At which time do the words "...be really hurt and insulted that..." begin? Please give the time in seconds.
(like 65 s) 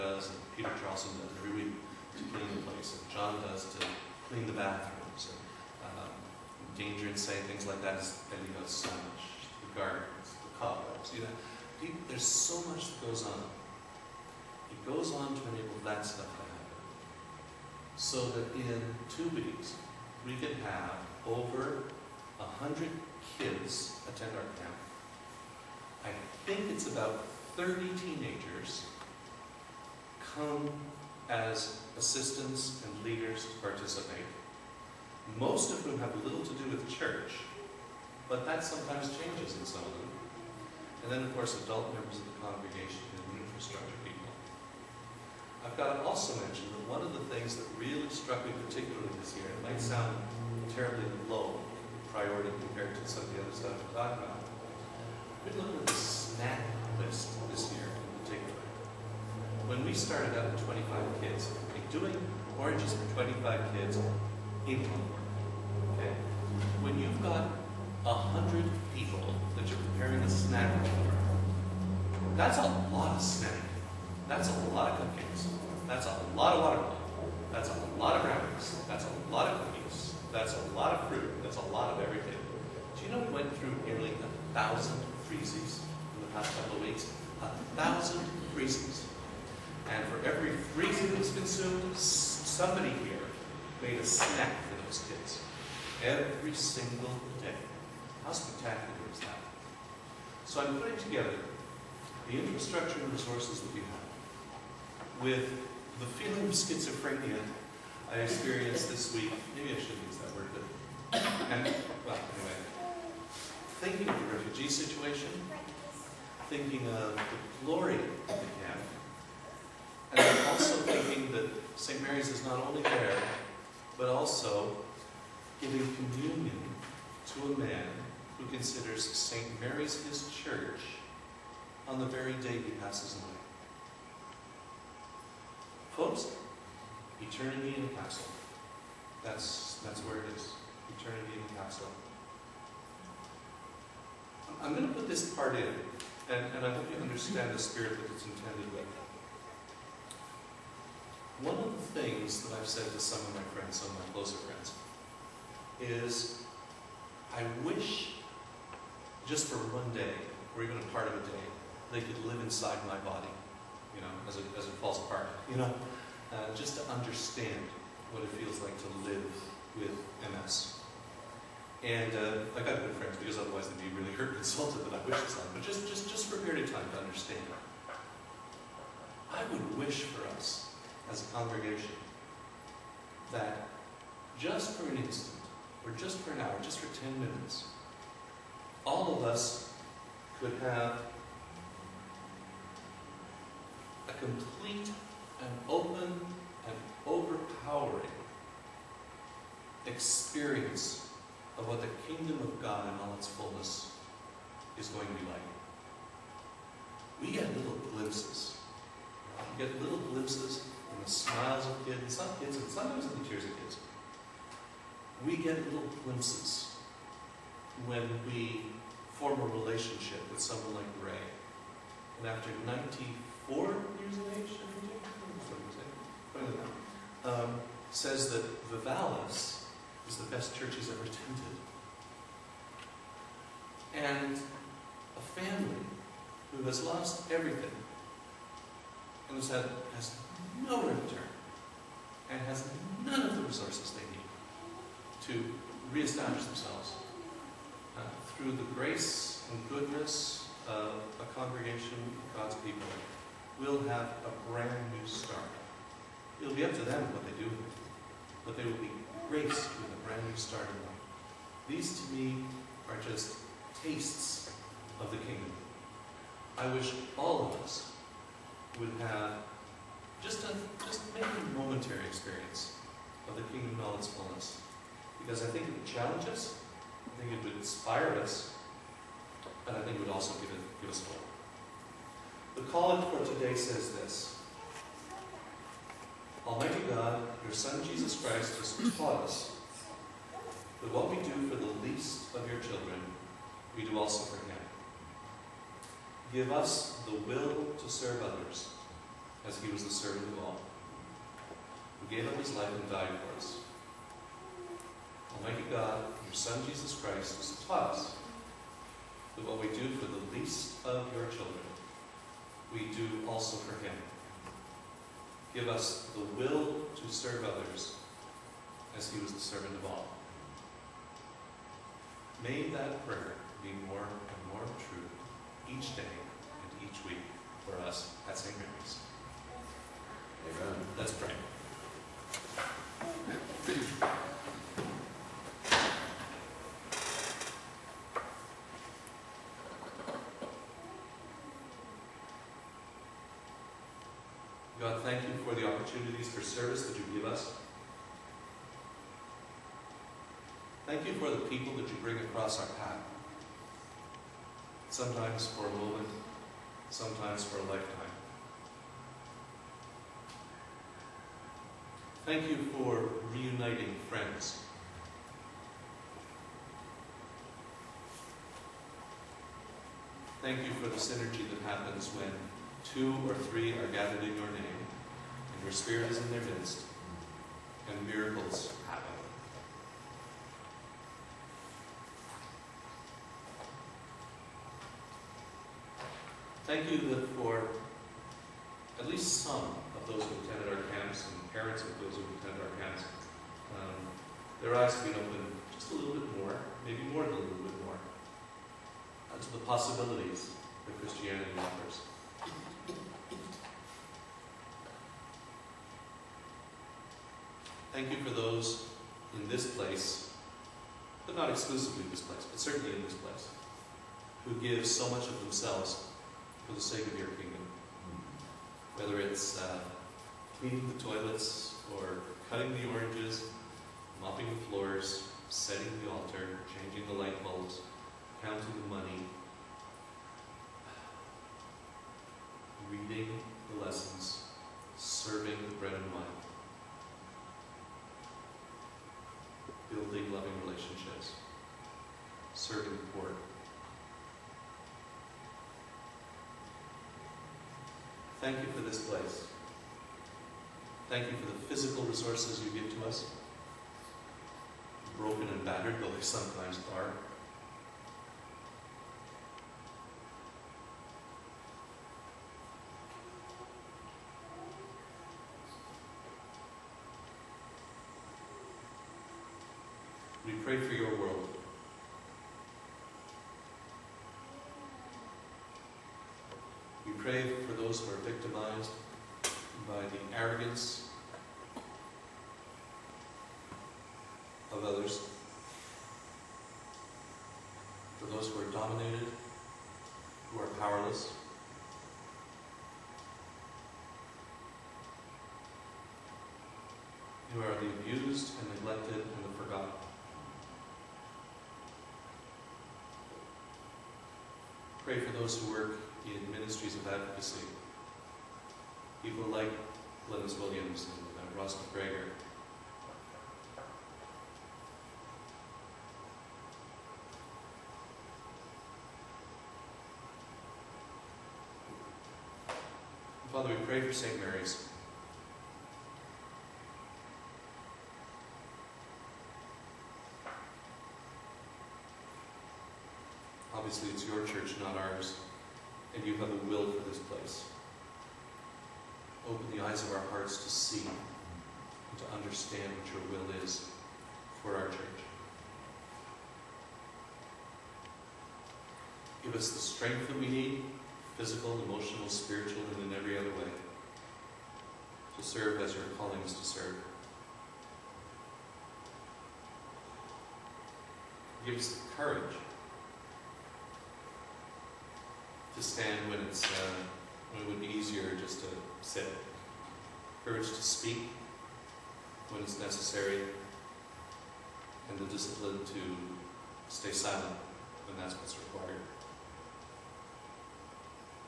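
173 s.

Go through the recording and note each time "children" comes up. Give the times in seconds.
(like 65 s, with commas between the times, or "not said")
292 s, 311 s.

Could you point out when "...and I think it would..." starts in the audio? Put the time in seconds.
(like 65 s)
279 s.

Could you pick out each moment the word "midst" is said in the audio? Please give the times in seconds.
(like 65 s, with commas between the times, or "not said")
376 s.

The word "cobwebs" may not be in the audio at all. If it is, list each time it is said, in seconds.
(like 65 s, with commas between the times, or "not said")
10 s.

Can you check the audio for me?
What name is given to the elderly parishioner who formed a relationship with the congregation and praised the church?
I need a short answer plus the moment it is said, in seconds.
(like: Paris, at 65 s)
Ray, at 221 s.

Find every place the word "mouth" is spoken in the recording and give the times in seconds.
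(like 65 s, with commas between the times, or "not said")
not said.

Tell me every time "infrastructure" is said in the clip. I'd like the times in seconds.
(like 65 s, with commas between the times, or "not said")
43 s, 102 s.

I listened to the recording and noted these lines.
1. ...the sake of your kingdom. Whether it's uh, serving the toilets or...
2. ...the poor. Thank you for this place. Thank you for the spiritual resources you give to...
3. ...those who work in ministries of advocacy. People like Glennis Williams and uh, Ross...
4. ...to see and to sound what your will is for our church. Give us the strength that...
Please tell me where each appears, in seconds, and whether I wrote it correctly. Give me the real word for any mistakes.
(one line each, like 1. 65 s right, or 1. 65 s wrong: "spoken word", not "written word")
1. 416 s wrong: "cleaning", not "serving"
2. 442 s wrong: "physical", not "spiritual"
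3. 505 s right
4. 540 s wrong: "understand", not "sound".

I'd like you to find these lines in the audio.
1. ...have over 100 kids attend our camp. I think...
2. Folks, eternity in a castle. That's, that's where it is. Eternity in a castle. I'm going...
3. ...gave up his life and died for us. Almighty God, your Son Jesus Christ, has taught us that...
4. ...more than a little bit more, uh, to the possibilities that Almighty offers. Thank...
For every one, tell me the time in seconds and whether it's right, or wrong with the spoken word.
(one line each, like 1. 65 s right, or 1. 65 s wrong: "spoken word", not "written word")
1. 20 s right
2. 135 s right
3. 302 s right
4. 397 s wrong: "Christianity", not "Almighty".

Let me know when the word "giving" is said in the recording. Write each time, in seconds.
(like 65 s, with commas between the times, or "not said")
125 s.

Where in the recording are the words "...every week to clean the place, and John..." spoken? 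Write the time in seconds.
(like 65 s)
1 s.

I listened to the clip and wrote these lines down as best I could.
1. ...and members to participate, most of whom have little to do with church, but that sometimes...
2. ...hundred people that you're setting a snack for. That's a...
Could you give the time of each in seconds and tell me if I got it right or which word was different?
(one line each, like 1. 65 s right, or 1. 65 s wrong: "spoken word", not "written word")
1. 32 s wrong: "leaders", not "members"
2. 68 s wrong: "preparing", not "setting".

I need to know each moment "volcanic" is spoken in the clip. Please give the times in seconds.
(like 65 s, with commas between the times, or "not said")
not said.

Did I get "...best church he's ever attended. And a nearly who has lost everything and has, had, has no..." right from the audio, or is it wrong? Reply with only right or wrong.
wrong.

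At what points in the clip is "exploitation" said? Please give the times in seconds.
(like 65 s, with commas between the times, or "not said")
not said.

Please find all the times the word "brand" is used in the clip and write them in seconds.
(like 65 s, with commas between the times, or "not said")
254 s, 260 s.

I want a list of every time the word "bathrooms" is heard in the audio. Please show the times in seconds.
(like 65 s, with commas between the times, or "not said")
4 s.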